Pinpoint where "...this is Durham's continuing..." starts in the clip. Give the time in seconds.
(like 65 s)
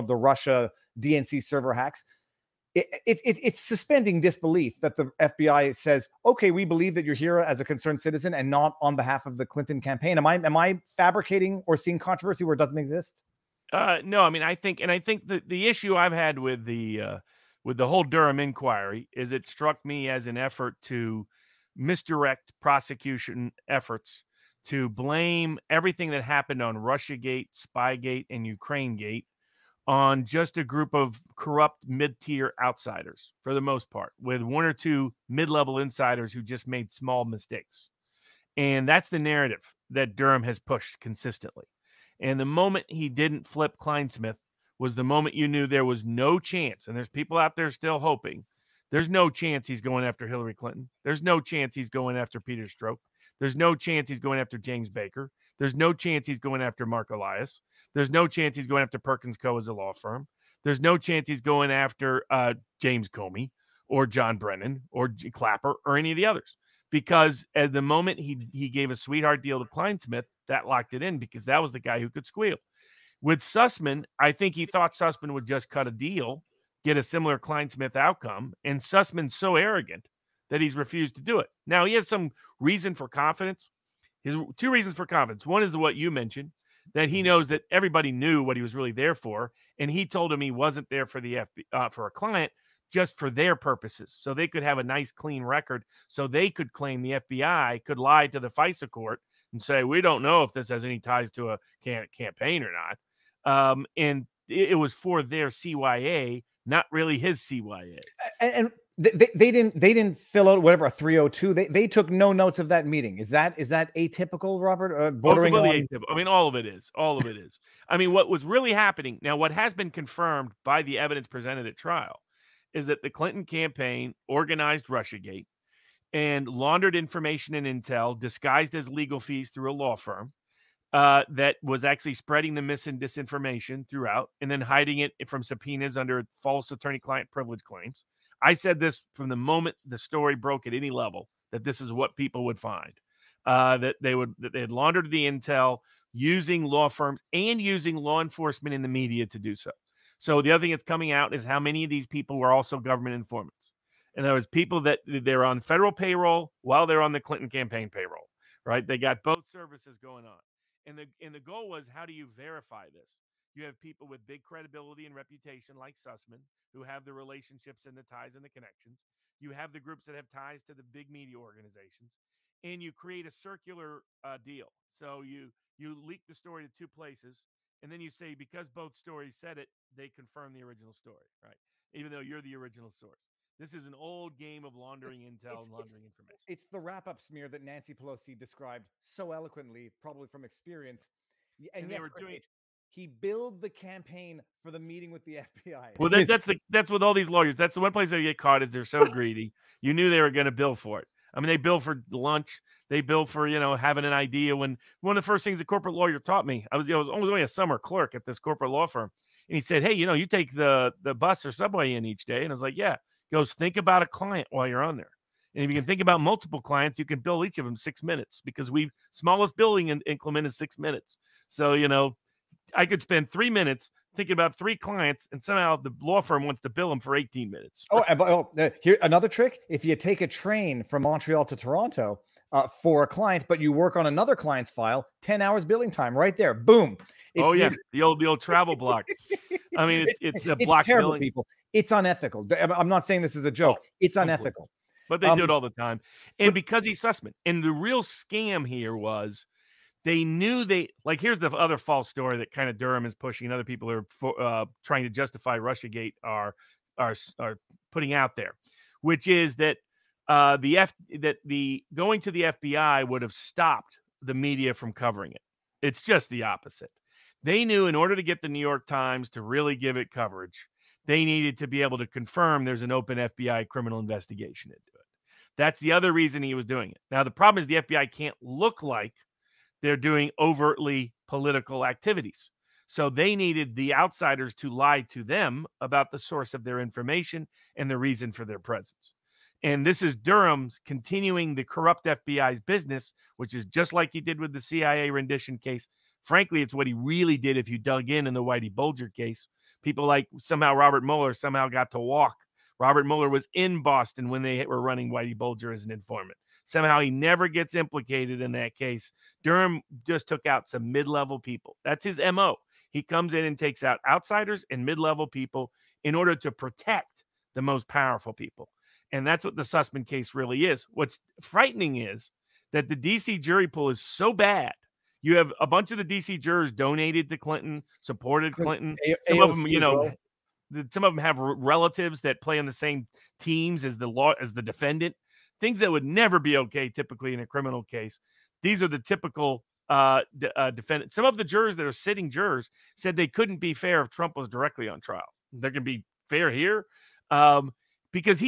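289 s.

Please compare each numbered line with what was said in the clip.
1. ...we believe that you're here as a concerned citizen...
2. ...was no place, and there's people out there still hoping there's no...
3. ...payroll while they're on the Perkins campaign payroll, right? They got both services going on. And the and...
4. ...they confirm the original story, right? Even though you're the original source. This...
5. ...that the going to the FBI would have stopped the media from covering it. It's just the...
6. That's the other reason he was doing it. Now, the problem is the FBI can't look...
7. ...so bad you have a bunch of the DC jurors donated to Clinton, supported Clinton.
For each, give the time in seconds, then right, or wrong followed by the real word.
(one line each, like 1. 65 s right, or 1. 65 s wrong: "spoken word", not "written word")
1. 6 s right
2. 45 s wrong: "chance", not "place"
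3. 155 s wrong: "Clinton", not "Perkins"
4. 179 s right
5. 261 s right
6. 275 s right
7. 324 s right.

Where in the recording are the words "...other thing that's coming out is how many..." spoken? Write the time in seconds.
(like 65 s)
150 s.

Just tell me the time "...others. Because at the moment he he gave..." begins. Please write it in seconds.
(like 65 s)
66 s.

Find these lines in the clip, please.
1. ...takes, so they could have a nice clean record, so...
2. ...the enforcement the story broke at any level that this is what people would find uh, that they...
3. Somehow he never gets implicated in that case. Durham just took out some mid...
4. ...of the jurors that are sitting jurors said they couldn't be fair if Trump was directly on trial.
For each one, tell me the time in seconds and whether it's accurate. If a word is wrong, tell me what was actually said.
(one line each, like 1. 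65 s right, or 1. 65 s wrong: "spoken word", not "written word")
1. 93 s wrong: "purposes", not "takes"
2. 139 s wrong: "moment", not "enforcement"
3. 306 s right
4. 341 s right.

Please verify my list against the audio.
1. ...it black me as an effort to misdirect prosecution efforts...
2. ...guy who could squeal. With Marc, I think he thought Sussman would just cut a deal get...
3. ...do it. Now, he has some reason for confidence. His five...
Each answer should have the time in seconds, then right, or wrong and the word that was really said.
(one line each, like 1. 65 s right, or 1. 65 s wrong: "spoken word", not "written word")
1. 19 s wrong: "struck", not "black"
2. 71 s wrong: "Sussman", not "Marc"
3. 81 s wrong: "two", not "five".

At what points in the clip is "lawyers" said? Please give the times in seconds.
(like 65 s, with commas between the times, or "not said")
197 s, 205 s.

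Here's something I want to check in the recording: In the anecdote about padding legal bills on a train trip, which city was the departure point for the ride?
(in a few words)
Montreal.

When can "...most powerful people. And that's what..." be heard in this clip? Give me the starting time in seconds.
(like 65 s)
317 s.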